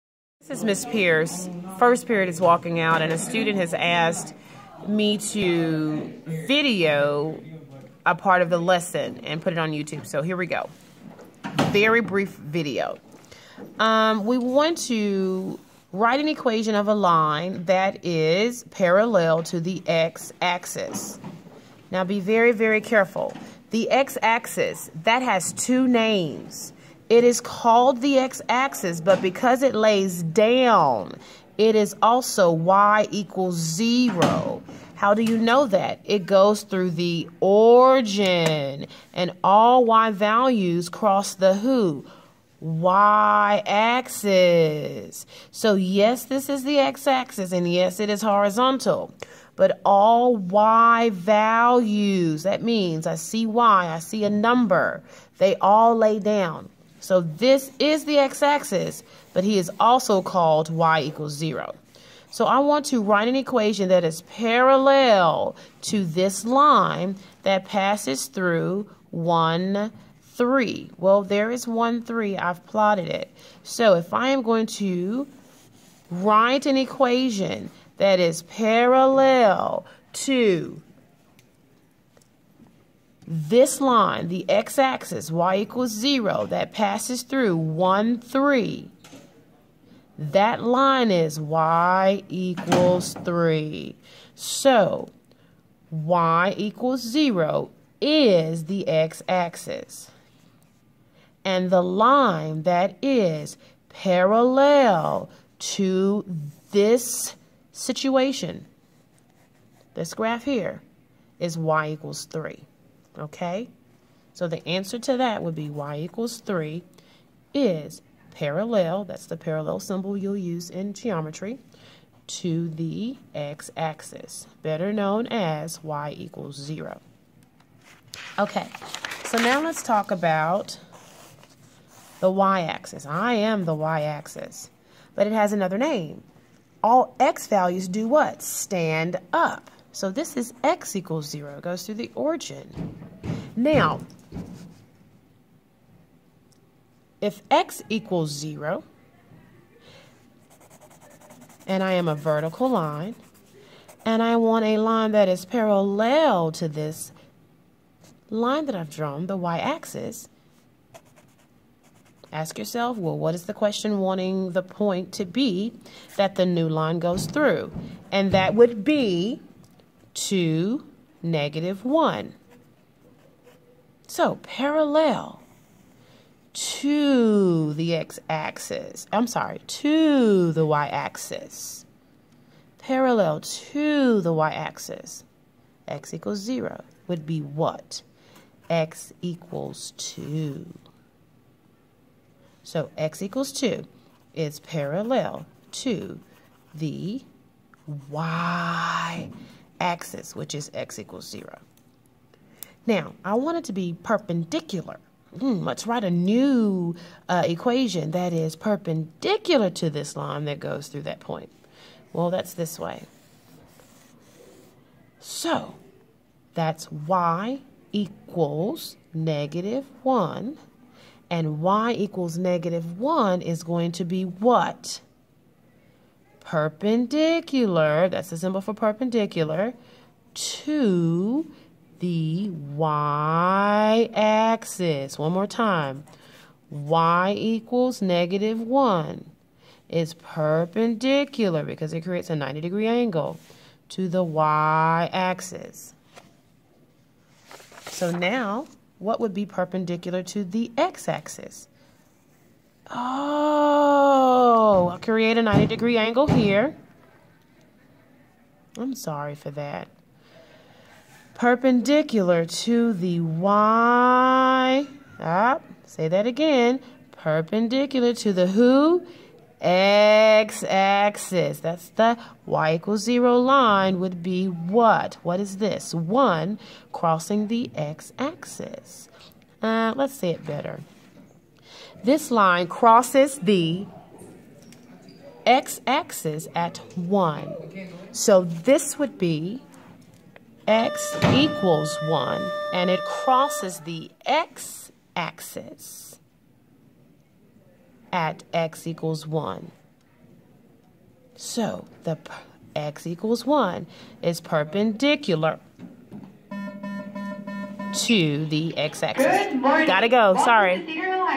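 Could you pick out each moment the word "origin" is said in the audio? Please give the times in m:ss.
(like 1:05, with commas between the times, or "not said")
0:37, 2:22.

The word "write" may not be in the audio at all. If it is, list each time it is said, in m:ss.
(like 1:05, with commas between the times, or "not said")
0:15, 1:03, 1:16, 3:25.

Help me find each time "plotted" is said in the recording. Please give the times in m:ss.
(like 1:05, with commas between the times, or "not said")
1:12.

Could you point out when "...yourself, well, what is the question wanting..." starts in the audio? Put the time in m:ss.
2:42.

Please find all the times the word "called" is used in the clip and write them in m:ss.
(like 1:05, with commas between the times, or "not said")
0:27, 1:00.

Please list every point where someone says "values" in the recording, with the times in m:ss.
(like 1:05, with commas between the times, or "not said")
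0:40, 0:51, 2:17.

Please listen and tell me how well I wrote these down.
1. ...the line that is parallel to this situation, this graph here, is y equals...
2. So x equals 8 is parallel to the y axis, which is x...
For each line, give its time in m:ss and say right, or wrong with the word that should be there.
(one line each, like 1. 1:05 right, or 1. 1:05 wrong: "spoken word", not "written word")
1. 1:41 right
2. 3:12 wrong: "2", not "8".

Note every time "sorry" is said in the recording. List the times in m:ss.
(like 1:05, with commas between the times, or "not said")
2:59, 4:18, 5:10.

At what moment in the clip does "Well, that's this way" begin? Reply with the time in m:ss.
3:32.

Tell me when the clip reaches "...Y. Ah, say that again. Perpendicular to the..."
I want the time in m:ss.
4:23.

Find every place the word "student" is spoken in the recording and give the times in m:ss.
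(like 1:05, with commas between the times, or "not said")
0:03.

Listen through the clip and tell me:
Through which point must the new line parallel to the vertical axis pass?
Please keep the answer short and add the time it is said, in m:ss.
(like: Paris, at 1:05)
(2, -1), at 2:50.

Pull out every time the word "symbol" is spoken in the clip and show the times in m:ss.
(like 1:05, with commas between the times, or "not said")
1:59, 3:48.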